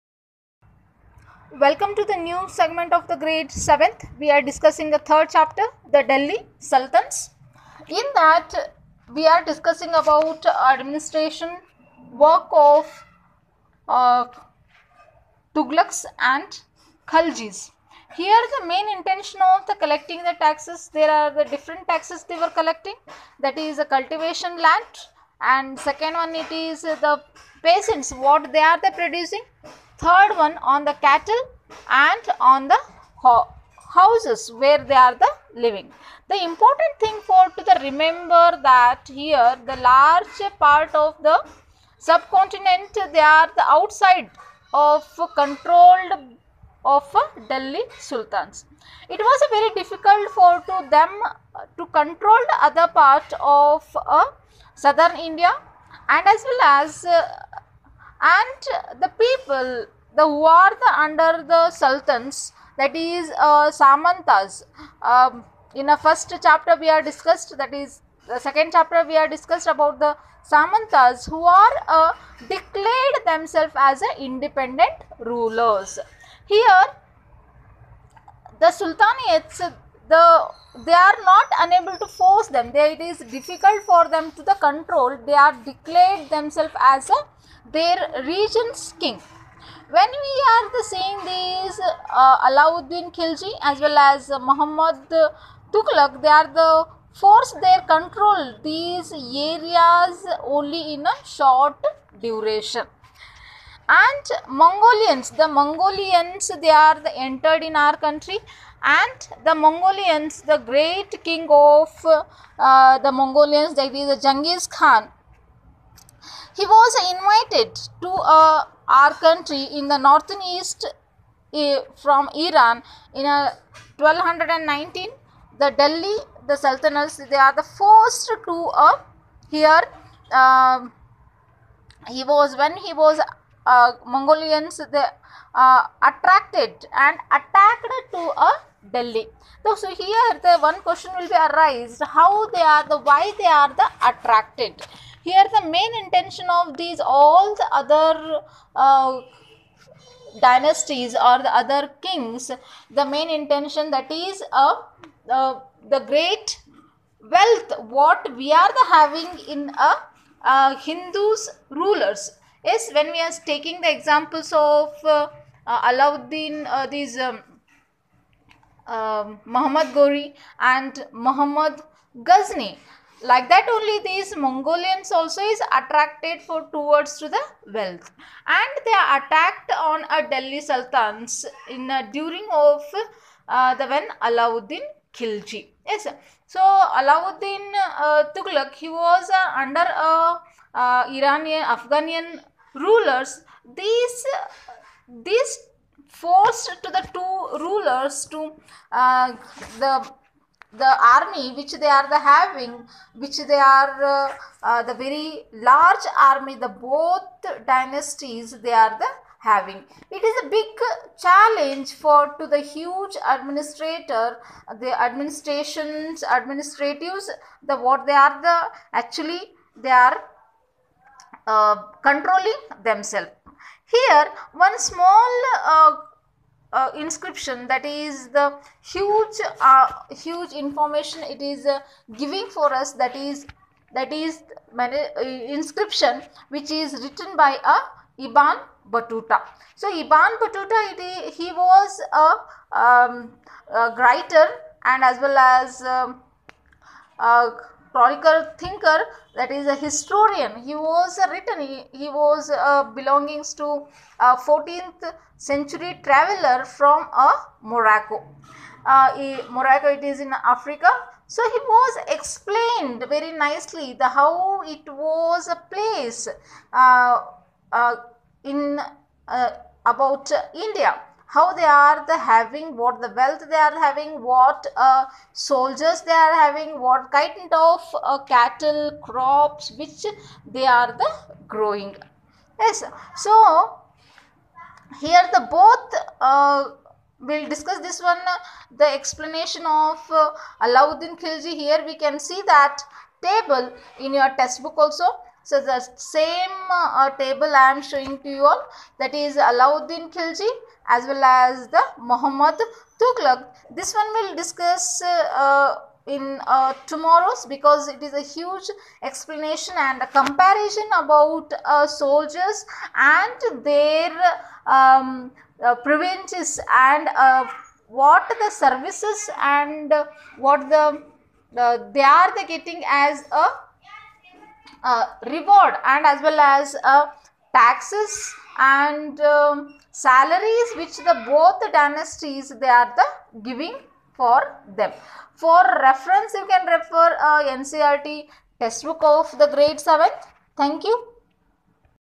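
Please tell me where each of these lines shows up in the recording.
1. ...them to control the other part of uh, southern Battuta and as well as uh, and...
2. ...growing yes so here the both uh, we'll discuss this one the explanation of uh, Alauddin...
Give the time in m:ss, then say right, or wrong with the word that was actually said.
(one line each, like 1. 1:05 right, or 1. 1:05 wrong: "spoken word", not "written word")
1. 0:50 wrong: "India", not "Battuta"
2. 4:41 right.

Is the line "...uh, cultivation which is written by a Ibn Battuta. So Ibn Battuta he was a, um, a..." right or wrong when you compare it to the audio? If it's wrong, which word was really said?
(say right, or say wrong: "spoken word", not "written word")
wrong: "inscription", not "cultivation".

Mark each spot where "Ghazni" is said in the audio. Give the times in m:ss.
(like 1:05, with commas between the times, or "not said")
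2:52.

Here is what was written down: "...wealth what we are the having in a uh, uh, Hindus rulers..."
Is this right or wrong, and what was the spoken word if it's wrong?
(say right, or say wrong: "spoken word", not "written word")
right.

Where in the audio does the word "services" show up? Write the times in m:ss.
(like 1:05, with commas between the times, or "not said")
5:18.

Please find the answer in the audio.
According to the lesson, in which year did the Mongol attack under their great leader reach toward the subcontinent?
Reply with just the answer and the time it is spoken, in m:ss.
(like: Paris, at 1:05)
1219, at 2:04.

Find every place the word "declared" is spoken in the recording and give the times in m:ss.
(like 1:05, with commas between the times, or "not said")
1:12, 1:25.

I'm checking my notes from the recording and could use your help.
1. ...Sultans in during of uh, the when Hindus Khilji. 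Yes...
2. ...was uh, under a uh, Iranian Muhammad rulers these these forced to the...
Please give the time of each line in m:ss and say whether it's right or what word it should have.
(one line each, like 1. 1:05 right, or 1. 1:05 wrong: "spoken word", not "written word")
1. 3:00 wrong: "Alauddin", not "Hindus"
2. 3:08 wrong: "Afghanian", not "Muhammad".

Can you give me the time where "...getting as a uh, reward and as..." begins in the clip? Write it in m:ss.
5:22.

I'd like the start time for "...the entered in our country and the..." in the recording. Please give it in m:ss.
1:47.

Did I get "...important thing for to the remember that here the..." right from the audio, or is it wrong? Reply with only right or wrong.
right.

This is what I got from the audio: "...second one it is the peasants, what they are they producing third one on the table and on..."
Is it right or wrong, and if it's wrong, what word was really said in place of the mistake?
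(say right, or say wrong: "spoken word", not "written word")
wrong: "cattle", not "table".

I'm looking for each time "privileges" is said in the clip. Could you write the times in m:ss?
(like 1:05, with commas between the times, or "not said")
5:15.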